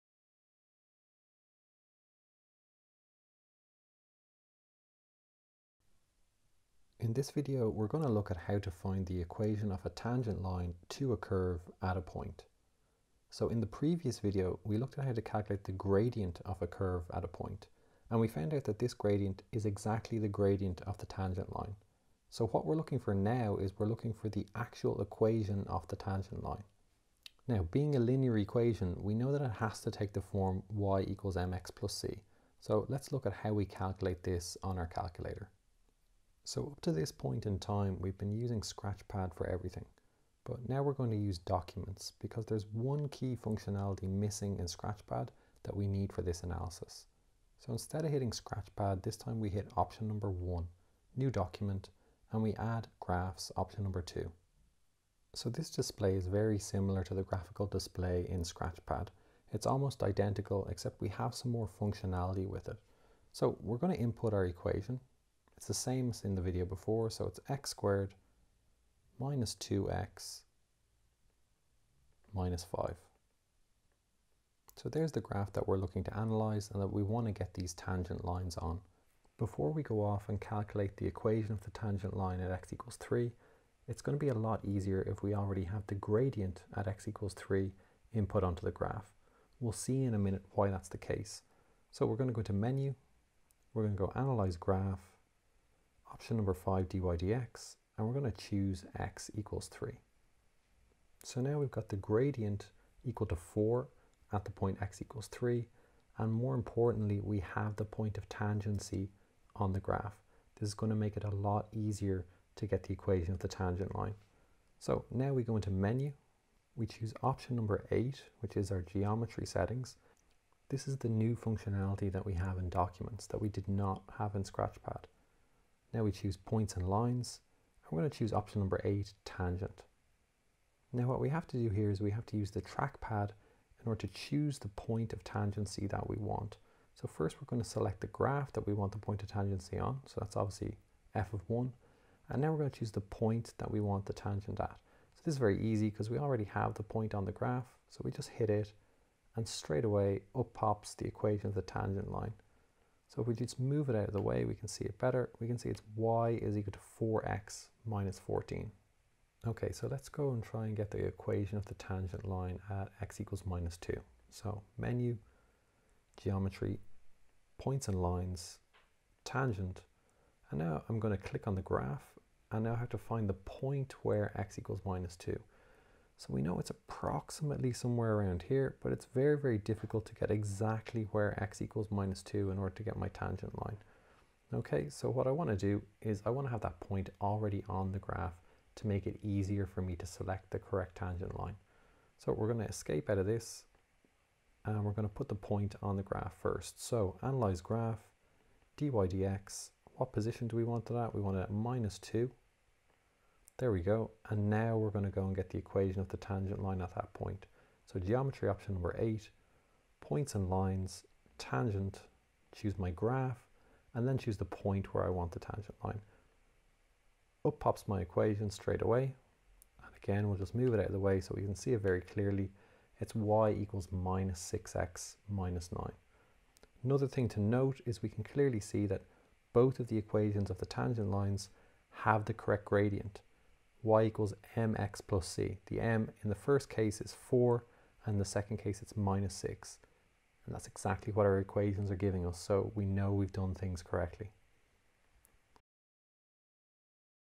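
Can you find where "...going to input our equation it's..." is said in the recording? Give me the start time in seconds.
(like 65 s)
63 s.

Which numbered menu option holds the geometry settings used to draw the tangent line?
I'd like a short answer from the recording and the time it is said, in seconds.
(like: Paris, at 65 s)
8, at 117 s.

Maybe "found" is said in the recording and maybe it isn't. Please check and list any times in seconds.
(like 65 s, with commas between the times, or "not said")
18 s.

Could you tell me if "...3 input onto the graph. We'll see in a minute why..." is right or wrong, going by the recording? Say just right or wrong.
right.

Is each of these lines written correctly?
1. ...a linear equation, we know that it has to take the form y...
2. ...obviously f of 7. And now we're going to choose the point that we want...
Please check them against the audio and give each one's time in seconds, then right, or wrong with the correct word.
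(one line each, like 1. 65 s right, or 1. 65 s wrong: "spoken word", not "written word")
1. 27 s right
2. 140 s wrong: "1", not "7".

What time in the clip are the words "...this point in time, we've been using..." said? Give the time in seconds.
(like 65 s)
36 s.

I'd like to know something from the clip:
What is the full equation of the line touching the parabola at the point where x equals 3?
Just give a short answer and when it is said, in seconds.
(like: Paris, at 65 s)
y = 4x - 14, at 155 s.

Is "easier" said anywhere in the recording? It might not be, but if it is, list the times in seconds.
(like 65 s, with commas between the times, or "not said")
84 s, 111 s, 189 s.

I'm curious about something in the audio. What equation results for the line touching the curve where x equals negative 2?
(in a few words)
y = -6x - 9.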